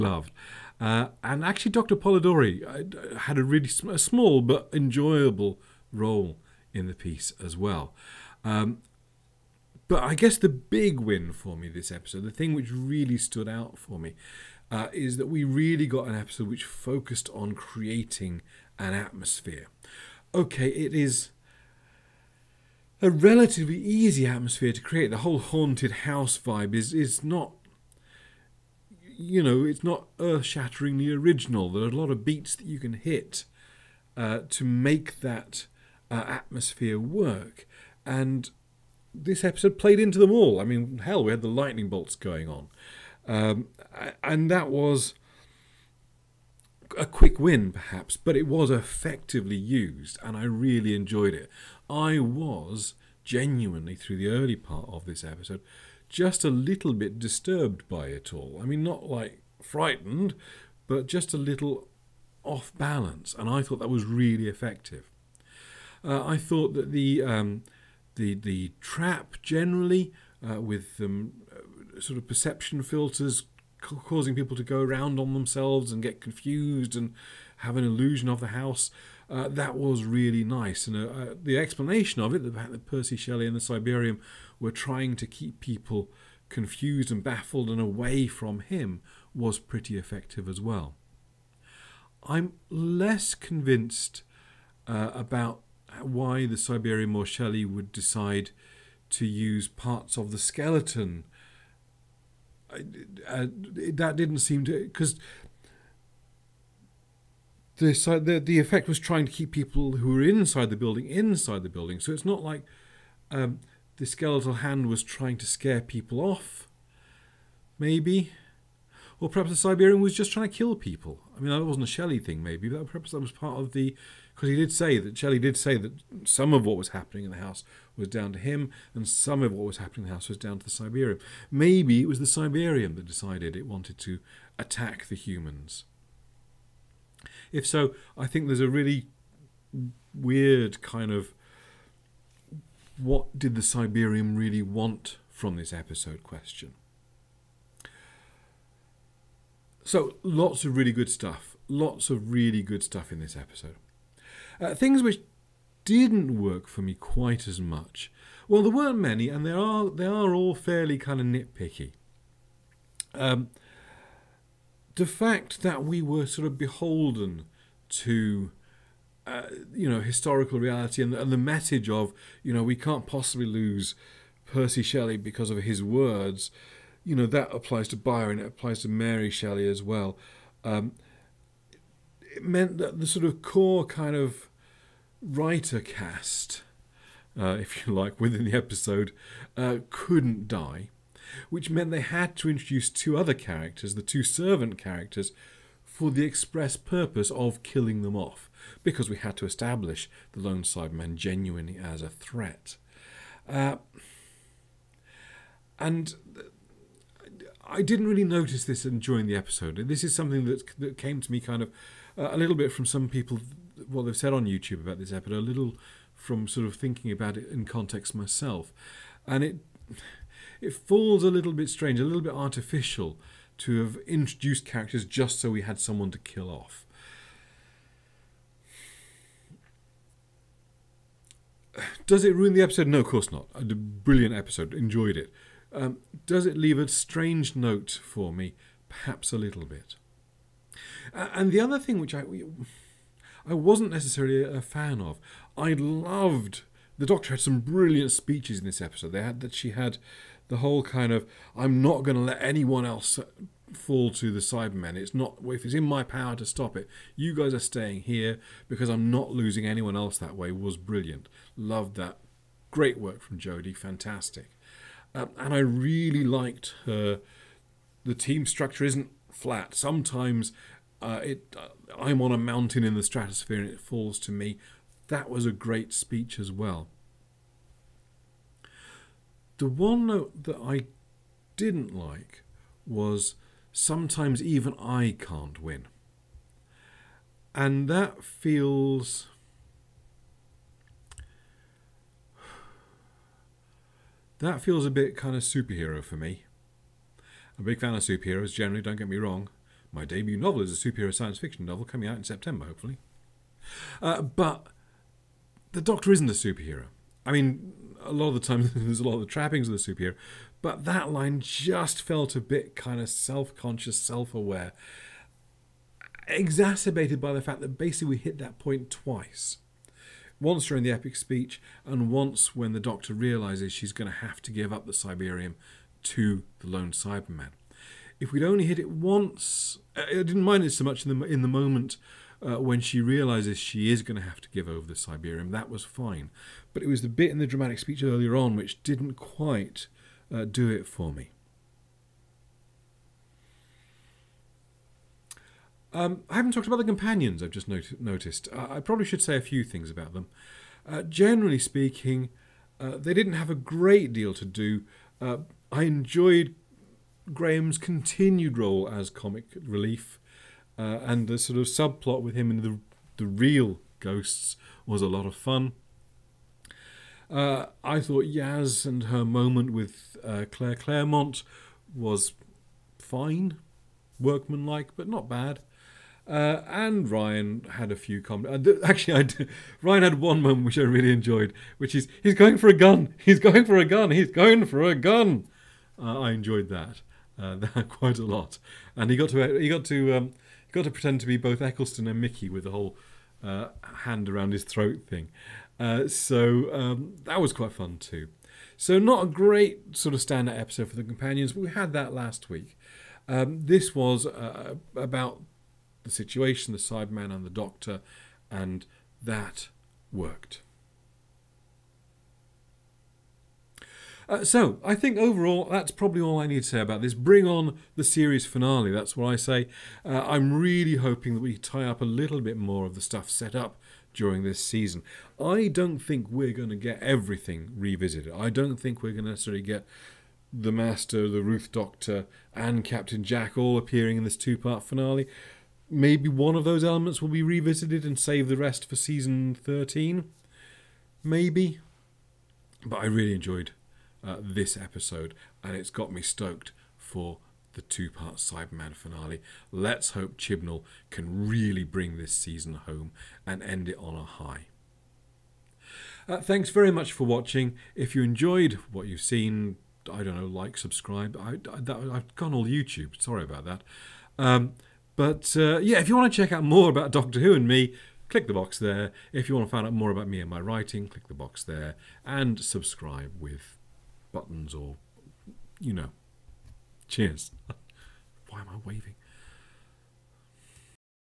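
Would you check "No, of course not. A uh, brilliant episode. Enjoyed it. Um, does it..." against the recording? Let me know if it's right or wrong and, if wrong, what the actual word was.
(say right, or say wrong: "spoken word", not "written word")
right.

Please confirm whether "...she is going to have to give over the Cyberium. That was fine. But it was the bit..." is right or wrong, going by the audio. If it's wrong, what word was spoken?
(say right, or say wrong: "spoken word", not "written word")
right.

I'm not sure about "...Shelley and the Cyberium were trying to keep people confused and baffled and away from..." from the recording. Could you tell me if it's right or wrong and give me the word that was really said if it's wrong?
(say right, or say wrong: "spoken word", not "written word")
right.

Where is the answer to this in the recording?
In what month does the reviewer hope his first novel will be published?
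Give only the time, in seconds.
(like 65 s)
302 s.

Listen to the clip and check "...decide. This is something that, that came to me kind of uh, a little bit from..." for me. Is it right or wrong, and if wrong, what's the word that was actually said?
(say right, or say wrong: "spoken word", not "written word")
wrong: "episode", not "decide".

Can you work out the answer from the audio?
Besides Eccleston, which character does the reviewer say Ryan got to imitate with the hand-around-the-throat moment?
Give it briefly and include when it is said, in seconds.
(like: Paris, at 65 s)
Mickey, at 392 s.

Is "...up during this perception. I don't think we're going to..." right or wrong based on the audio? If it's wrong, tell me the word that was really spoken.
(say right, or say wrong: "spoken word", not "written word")
wrong: "season", not "perception".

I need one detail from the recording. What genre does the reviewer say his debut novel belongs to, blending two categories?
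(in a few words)
Superhero science fiction.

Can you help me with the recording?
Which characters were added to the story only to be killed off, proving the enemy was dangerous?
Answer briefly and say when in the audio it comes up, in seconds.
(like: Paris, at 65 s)
Two servant characters, at 193 s.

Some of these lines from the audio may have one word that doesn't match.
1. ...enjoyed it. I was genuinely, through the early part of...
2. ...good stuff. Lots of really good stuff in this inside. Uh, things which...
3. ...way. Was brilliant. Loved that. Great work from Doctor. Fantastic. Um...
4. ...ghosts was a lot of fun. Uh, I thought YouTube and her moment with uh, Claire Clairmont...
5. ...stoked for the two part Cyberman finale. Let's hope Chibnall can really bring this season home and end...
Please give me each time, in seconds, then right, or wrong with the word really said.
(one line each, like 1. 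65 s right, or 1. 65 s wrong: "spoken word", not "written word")
1. 50 s right
2. 150 s wrong: "episode", not "inside"
3. 260 s wrong: "Jodie", not "Doctor"
4. 363 s wrong: "Yaz", not "YouTube"
5. 446 s right.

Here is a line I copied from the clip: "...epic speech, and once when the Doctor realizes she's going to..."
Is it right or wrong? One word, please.
right.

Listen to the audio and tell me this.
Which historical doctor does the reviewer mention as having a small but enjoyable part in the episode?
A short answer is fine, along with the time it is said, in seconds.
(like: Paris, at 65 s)
Dr. Polidori, at 1 s.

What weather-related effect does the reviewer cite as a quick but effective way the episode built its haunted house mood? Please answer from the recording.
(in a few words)
Lightning bolts.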